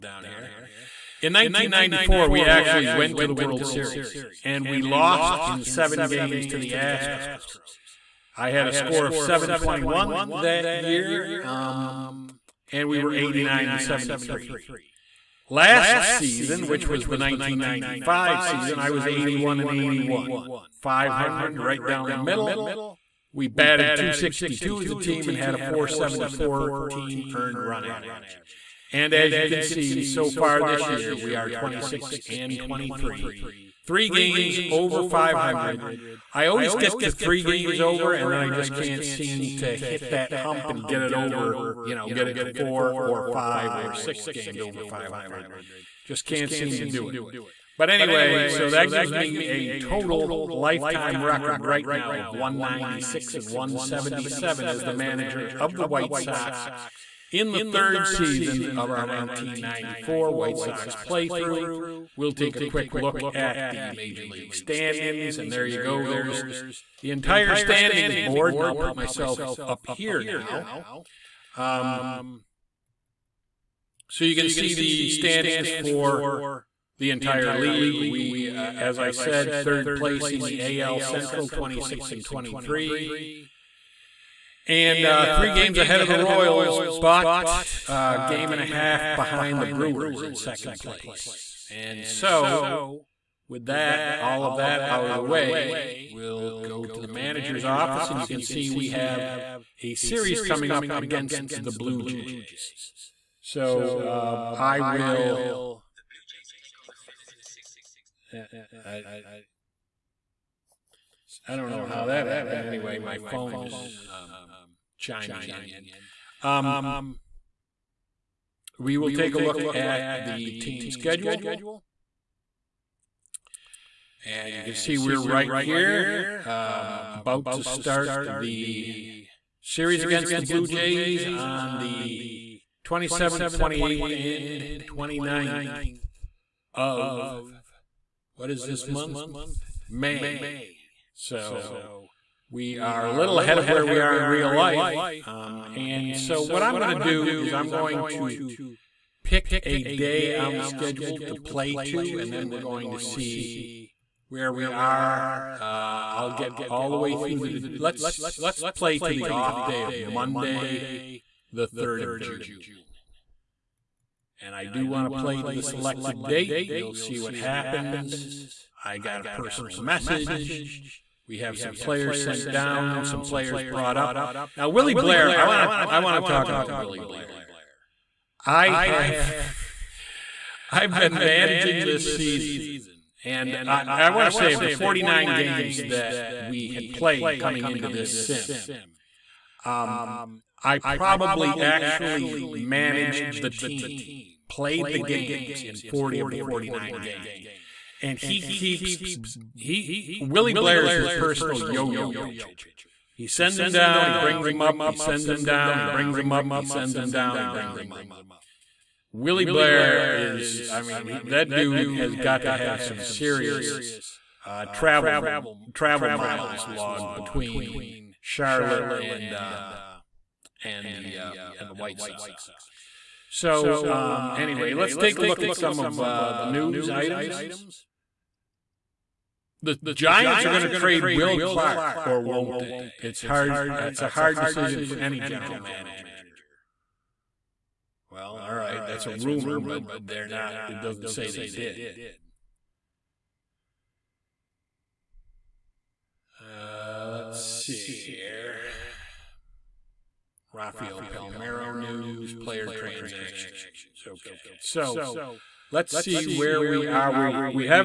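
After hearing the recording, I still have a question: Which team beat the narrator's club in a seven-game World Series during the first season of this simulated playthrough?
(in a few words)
Astros.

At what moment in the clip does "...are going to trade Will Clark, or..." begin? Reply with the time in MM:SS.
03:50.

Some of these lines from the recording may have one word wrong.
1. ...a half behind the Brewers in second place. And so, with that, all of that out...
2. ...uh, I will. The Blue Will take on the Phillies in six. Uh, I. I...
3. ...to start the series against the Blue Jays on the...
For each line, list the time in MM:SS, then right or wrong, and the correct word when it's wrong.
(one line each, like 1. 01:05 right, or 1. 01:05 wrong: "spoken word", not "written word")
1. 01:28 right
2. 01:43 wrong: "Jays", not "Will"
3. 02:07 right.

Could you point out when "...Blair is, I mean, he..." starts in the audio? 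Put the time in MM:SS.
03:29.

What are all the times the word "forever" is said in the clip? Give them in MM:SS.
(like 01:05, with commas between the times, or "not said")
not said.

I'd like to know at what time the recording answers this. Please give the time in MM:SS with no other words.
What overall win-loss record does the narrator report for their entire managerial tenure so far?
00:52.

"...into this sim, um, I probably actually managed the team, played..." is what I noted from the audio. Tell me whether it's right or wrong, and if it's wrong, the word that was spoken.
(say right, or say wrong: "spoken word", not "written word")
right.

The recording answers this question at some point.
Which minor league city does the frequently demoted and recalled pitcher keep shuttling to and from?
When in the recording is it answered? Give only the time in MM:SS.
03:38.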